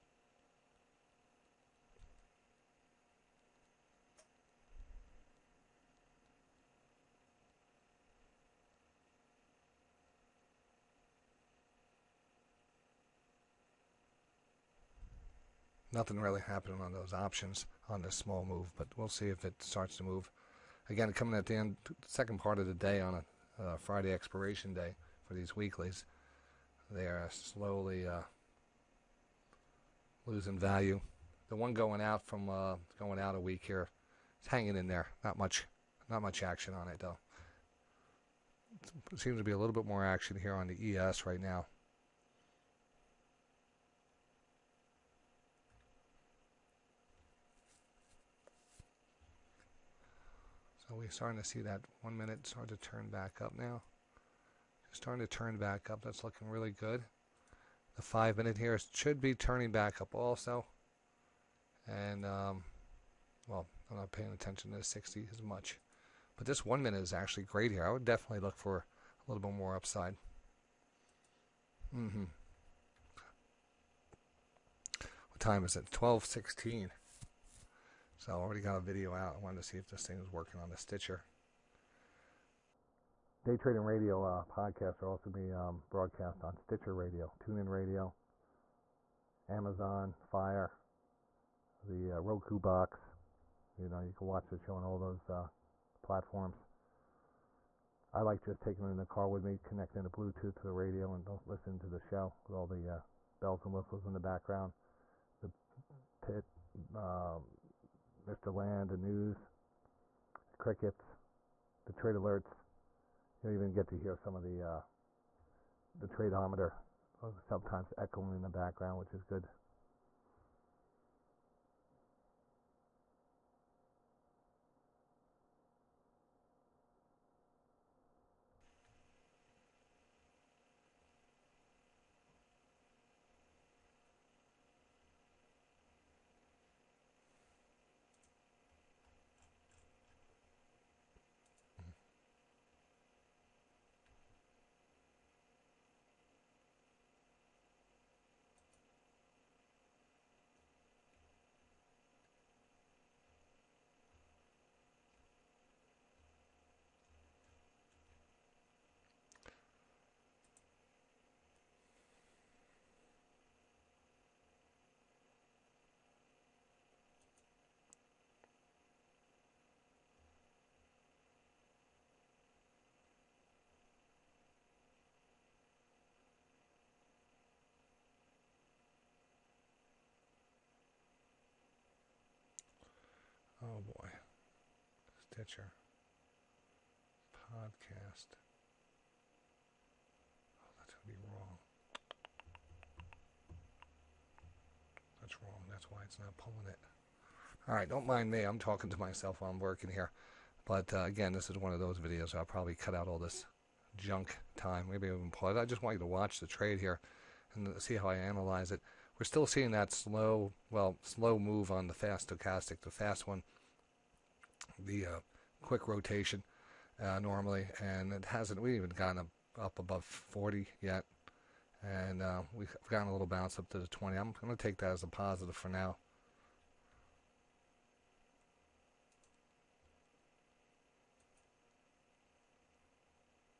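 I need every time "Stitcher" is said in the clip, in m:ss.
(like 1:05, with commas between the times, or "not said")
1:20, 1:26, 3:05.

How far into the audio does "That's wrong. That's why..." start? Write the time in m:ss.
3:15.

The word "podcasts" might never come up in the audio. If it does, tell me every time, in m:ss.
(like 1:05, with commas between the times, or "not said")
1:24, 3:07.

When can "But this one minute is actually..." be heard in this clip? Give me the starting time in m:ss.
1:06.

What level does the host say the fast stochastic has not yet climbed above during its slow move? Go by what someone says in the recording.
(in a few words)
40.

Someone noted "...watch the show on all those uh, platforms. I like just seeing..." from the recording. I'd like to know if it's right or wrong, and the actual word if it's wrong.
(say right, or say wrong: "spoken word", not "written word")
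wrong: "taking", not "seeing".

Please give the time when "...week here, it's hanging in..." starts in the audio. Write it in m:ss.
0:33.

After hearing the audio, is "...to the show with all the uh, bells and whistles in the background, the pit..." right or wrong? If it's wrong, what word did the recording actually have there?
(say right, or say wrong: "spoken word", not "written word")
right.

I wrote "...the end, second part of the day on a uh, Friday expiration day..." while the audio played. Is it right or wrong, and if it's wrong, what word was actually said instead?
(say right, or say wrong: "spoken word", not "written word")
right.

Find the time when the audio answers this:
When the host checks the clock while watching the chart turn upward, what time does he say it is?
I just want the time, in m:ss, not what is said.
1:15.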